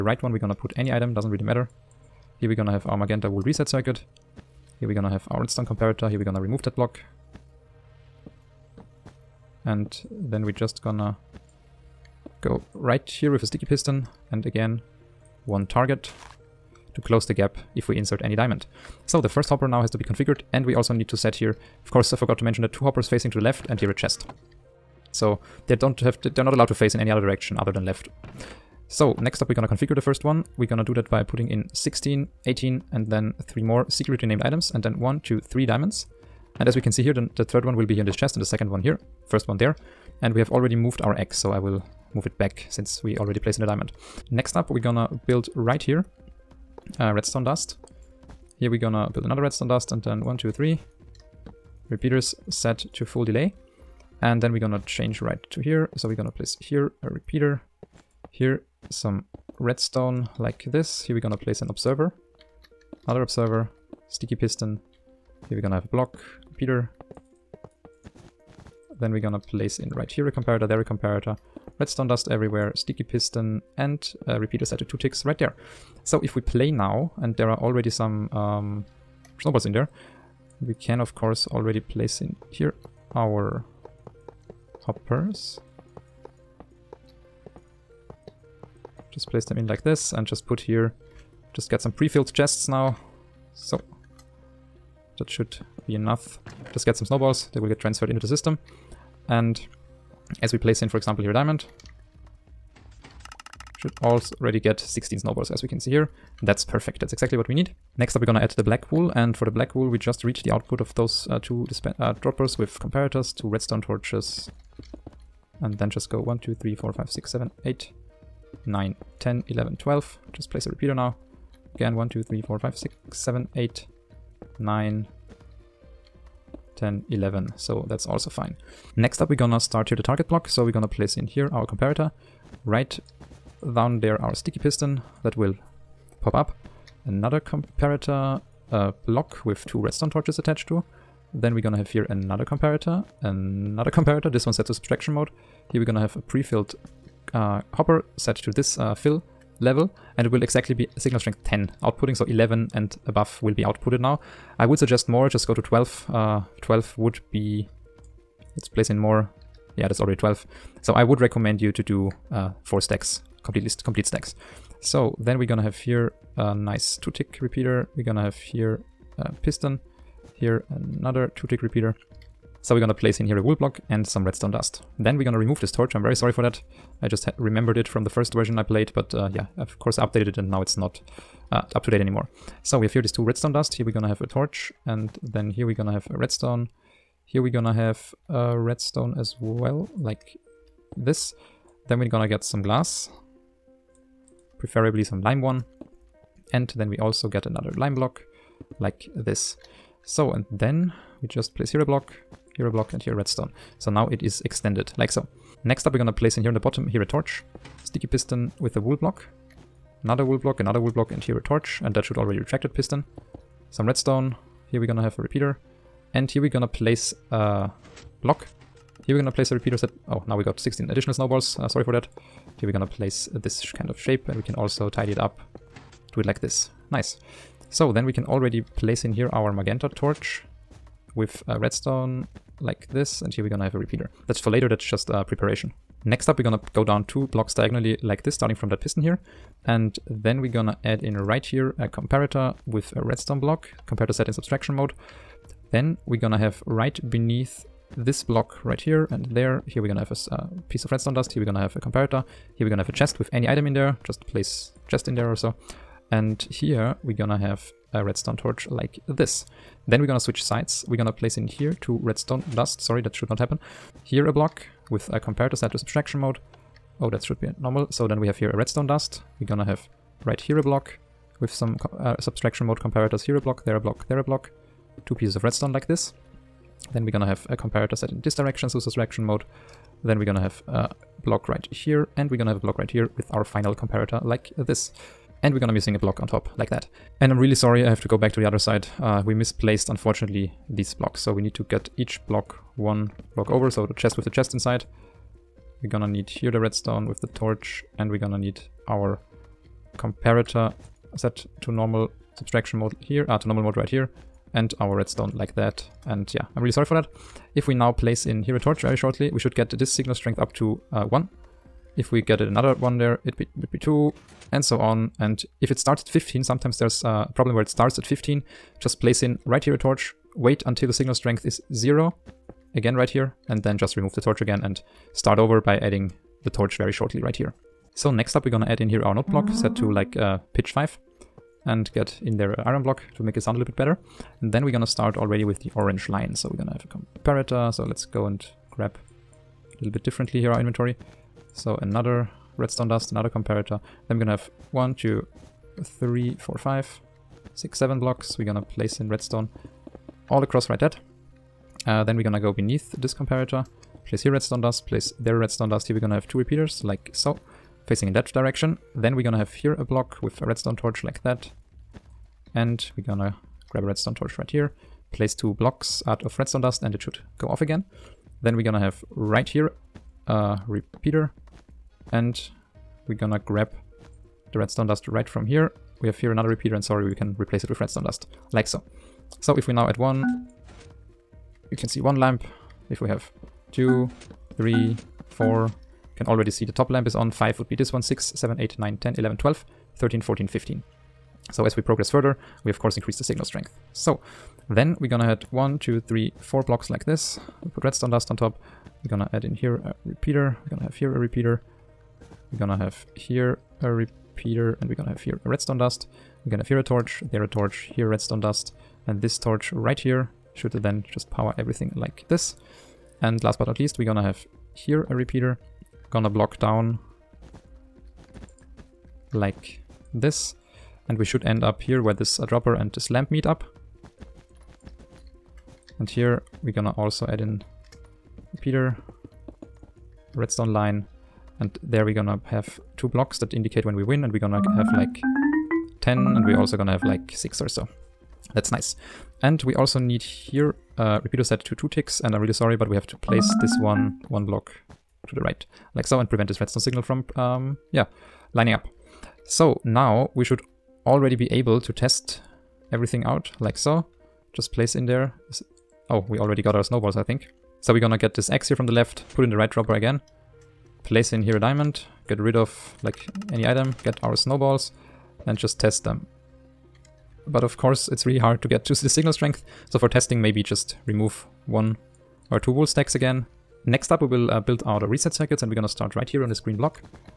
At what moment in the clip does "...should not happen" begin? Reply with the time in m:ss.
4:23.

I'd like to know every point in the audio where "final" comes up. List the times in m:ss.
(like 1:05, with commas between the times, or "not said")
4:43.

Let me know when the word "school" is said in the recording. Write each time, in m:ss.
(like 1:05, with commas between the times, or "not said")
not said.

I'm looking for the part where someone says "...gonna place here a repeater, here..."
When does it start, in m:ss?
0:56.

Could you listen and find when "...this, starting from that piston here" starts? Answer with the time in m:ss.
3:58.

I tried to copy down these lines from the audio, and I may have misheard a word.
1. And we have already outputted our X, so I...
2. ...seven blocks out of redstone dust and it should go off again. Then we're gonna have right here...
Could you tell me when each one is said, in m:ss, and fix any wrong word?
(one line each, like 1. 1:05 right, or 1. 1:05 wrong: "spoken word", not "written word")
1. 0:40 wrong: "moved", not "outputted"
2. 6:05 wrong: "two", not "seven".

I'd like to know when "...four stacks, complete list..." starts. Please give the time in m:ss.
2:42.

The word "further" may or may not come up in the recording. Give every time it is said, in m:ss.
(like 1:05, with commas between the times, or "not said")
6:32.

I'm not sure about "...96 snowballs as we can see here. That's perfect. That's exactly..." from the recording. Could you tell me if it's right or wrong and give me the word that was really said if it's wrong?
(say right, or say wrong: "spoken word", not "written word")
wrong: "16", not "96".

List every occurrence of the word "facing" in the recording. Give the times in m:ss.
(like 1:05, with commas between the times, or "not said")
0:23, 5:57.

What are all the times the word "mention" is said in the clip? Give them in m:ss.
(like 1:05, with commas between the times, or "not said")
0:22.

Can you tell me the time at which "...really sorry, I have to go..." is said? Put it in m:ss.
4:47.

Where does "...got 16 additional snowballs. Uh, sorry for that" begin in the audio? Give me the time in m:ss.
3:40.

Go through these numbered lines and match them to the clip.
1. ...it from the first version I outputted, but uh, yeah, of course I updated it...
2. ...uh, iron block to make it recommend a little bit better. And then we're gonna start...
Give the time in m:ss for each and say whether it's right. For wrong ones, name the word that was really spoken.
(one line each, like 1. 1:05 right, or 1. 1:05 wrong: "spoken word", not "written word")
1. 2:57 wrong: "played", not "outputted"
2. 5:32 wrong: "sound", not "recommend".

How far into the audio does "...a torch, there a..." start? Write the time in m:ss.
6:46.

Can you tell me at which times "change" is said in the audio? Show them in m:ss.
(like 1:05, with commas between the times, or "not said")
0:54.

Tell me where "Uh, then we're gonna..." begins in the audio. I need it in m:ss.
5:51.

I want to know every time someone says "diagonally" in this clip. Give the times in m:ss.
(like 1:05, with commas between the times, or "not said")
3:57.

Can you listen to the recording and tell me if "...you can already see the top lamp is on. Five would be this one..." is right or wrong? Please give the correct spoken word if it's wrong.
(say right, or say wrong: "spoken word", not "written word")
right.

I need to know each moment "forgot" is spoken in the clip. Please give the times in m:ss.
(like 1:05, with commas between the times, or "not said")
0:22.